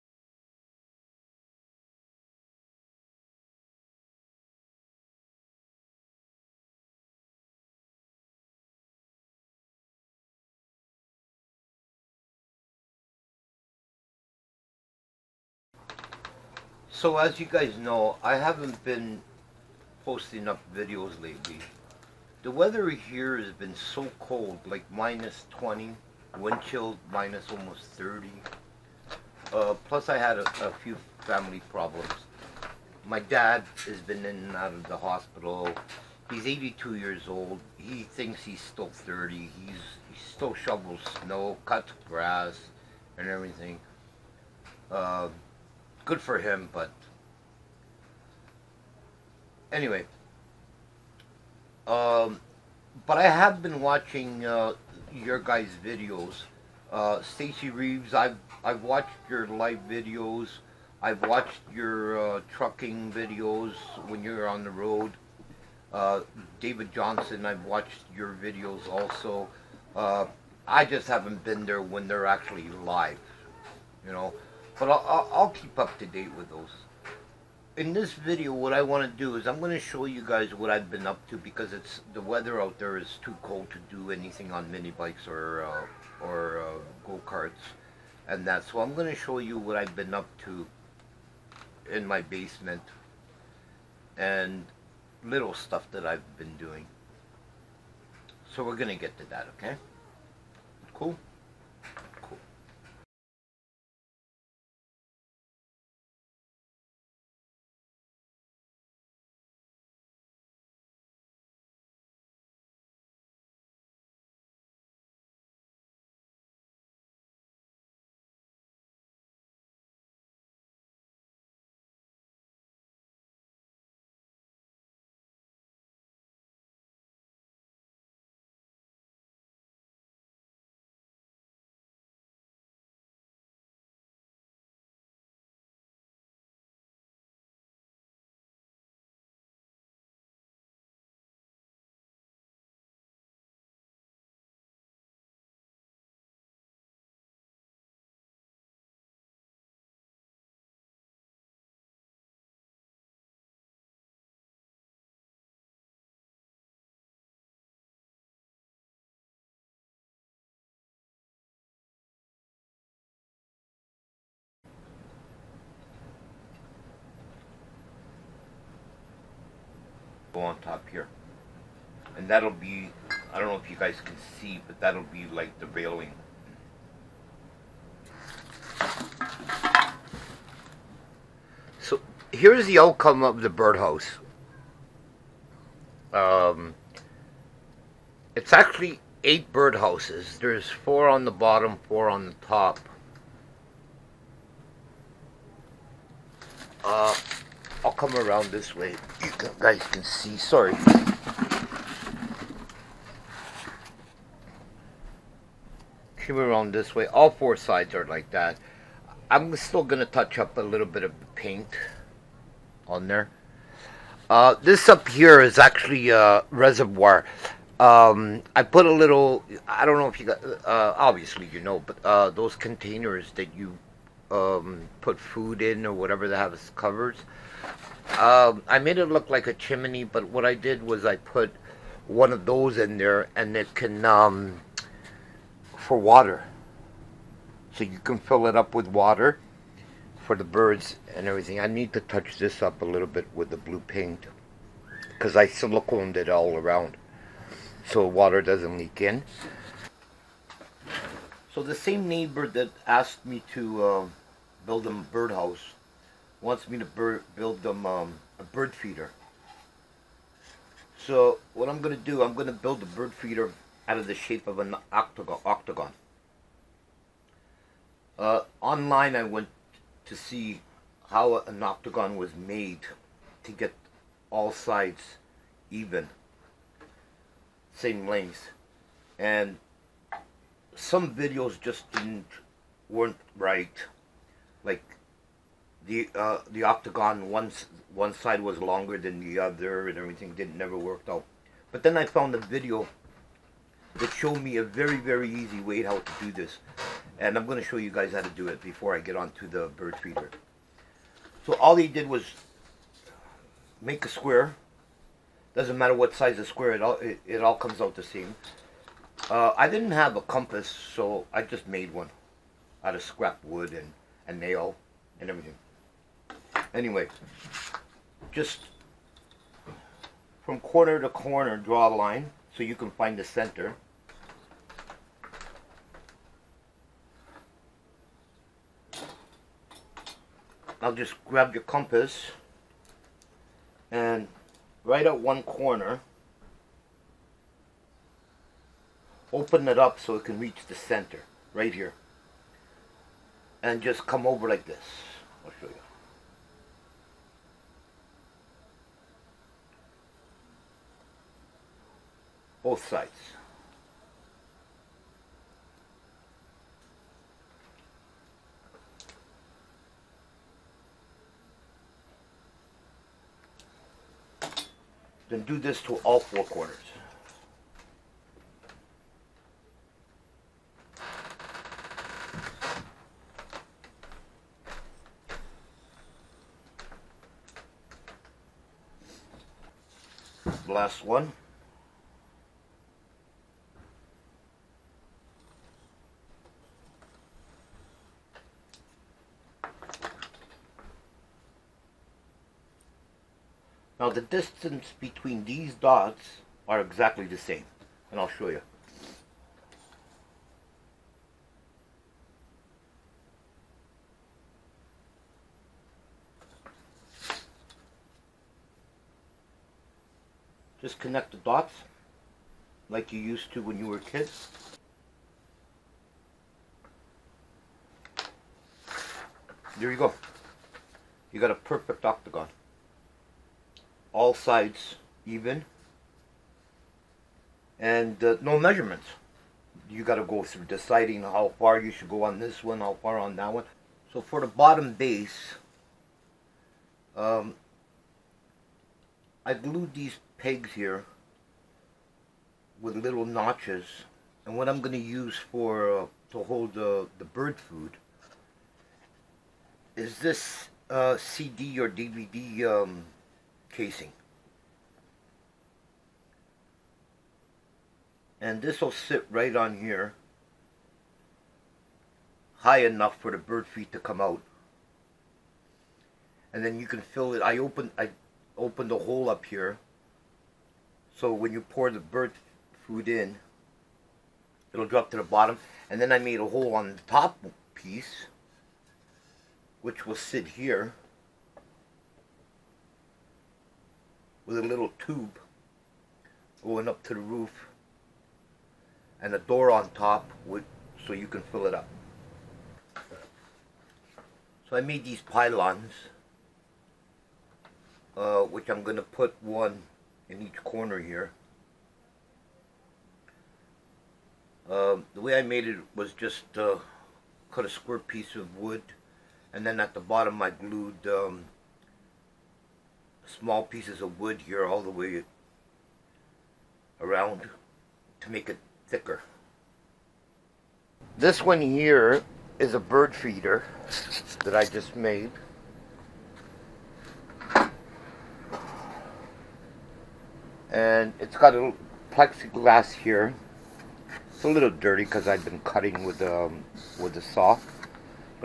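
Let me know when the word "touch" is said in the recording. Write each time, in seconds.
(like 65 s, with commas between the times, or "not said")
210 s, 242 s.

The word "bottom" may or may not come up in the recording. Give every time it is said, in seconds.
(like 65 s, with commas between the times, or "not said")
191 s, 434 s, 475 s, 510 s.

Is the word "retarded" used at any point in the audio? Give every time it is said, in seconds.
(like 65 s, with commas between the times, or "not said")
not said.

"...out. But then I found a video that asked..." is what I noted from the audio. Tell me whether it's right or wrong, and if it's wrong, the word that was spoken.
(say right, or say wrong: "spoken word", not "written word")
wrong: "showed", not "asked".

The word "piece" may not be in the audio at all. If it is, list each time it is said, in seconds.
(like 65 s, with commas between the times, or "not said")
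477 s, 507 s, 513 s.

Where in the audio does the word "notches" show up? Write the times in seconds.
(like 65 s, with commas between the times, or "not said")
443 s.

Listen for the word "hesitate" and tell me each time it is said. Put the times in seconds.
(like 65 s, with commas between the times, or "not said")
not said.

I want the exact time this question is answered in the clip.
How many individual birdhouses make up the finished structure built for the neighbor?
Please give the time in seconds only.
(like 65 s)
189 s.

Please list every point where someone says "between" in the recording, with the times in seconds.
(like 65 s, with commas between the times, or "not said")
394 s.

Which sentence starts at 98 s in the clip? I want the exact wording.
So we're going to get to that, okay?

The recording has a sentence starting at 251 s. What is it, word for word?
So the same neighbor that asked me to uh, build a birdhouse wants me to build them um, a bird feeder.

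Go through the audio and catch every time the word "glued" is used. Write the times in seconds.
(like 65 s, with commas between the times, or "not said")
439 s, 510 s.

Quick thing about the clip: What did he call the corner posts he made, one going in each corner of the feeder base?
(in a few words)
Pylons.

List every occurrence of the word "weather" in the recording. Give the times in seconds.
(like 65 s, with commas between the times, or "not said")
22 s, 82 s.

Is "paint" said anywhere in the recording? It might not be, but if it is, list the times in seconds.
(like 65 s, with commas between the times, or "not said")
211 s, 243 s.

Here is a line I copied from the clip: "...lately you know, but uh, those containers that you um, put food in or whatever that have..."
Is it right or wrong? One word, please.
wrong.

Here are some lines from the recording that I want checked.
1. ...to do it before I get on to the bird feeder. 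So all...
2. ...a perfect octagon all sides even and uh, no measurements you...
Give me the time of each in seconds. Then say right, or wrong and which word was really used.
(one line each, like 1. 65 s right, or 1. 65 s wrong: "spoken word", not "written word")
1. 298 s right
2. 421 s right.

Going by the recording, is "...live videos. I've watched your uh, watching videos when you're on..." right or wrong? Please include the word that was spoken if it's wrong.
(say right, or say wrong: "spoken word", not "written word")
wrong: "trucking", not "watching".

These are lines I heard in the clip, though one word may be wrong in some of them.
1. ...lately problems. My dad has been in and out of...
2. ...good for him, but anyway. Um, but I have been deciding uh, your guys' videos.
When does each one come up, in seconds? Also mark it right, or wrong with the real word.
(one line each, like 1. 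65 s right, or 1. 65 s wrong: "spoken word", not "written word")
1. 31 s wrong: "family", not "lately"
2. 46 s wrong: "watching", not "deciding".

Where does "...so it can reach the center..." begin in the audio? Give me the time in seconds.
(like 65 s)
339 s.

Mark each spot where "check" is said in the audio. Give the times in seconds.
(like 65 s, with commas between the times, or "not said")
not said.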